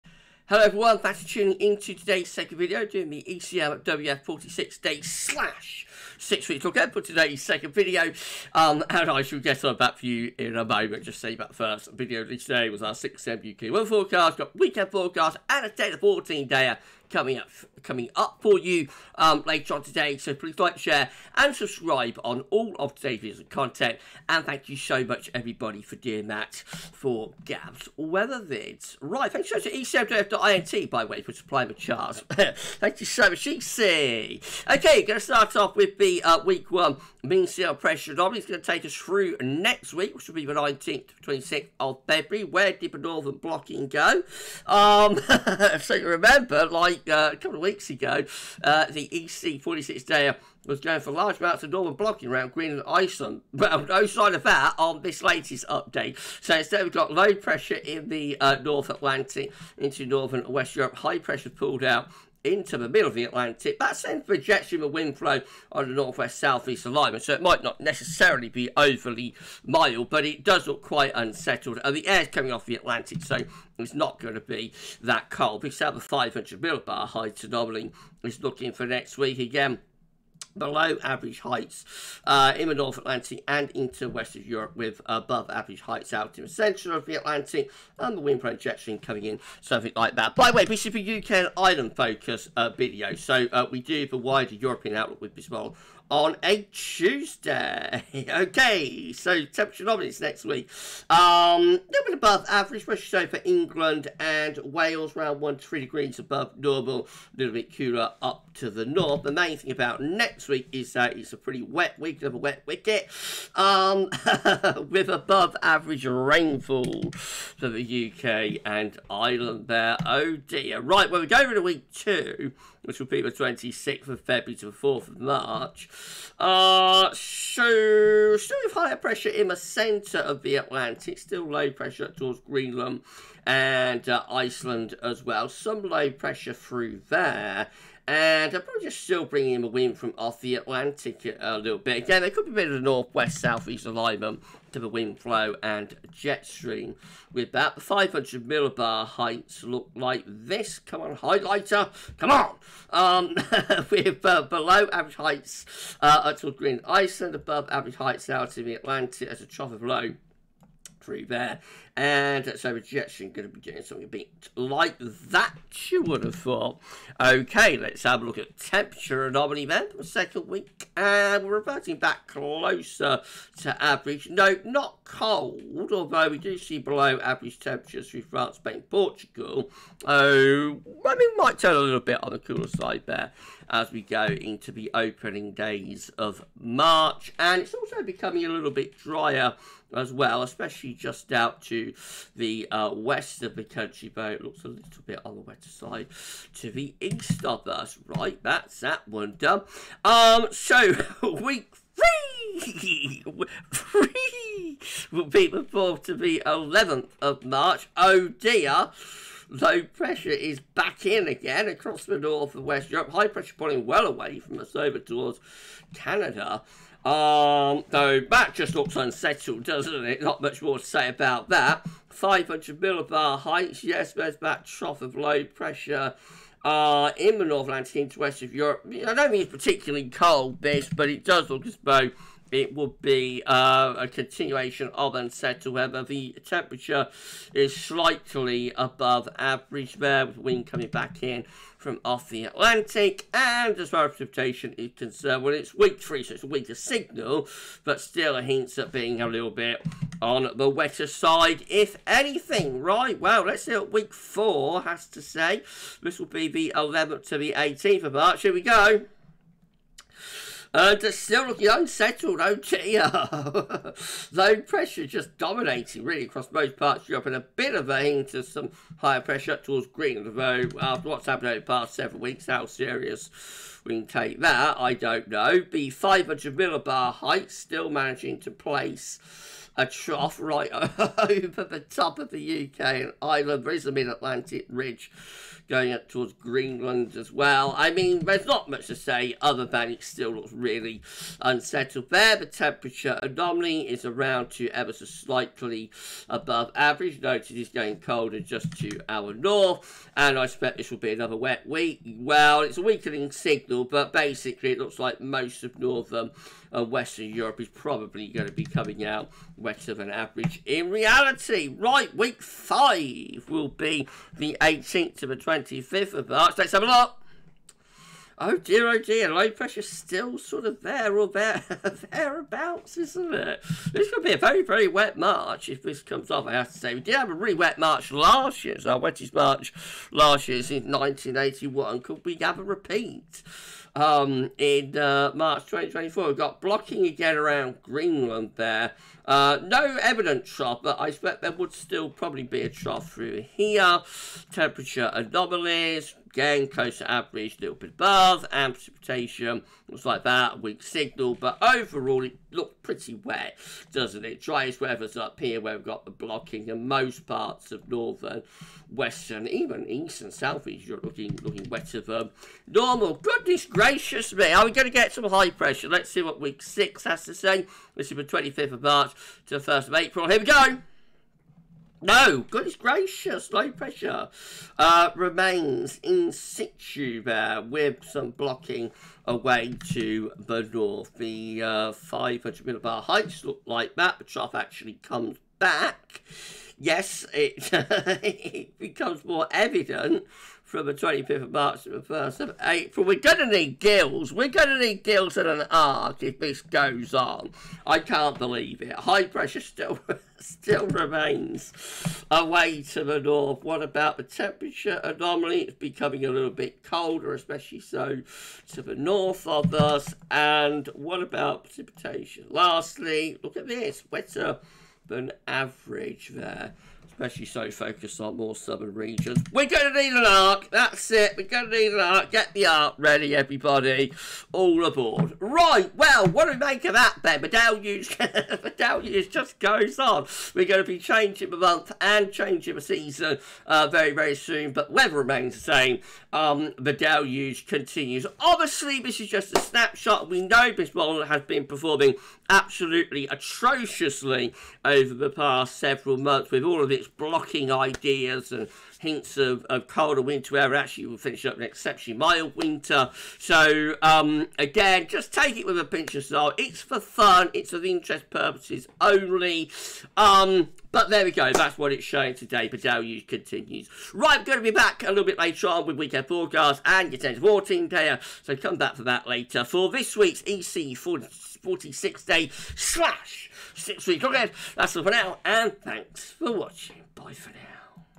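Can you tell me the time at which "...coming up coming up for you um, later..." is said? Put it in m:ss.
0:17.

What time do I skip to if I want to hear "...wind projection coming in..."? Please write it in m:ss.
1:28.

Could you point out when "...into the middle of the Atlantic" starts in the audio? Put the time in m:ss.
1:02.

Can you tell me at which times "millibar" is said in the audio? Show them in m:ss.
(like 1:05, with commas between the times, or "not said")
1:16, 2:28, 3:42, 4:36, 6:22.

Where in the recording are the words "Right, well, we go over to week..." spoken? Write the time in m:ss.
2:00.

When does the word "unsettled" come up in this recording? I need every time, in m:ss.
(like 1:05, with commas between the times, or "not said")
1:11, 3:38, 3:55, 4:21, 4:51.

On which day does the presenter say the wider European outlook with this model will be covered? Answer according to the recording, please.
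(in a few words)
Tuesday.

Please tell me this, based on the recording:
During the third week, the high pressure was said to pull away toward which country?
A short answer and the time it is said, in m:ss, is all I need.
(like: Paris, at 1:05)
Canada, at 3:35.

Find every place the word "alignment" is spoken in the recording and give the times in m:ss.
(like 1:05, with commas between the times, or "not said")
1:06, 2:23.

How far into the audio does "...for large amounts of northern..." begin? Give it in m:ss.
0:51.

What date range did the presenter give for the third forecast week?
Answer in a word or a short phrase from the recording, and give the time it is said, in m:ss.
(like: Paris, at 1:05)
4th to 11th March, at 3:25.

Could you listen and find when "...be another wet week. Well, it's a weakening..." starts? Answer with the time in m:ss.
5:00.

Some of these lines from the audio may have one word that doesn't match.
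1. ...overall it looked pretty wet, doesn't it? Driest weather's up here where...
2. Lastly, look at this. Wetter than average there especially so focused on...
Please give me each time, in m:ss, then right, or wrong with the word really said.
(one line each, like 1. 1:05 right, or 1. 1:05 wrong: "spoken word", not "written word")
1. 5:51 right
2. 6:52 right.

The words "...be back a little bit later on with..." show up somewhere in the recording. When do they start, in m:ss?
7:44.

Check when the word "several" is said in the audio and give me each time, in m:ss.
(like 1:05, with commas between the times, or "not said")
4:31, 7:25.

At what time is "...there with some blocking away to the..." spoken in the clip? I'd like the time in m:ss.
6:17.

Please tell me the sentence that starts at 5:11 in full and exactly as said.
Right, week five will be the 18th to the 25th of March.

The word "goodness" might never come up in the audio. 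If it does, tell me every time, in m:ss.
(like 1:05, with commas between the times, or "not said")
6:03, 6:12.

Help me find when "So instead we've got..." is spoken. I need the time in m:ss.
0:56.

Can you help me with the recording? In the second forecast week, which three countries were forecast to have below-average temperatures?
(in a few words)
France, Spain, Portugal.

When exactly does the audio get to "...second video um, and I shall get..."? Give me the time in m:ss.
0:07.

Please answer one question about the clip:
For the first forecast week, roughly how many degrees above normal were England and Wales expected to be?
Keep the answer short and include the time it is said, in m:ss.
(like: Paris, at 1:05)
1 to 3 degrees, at 1:45.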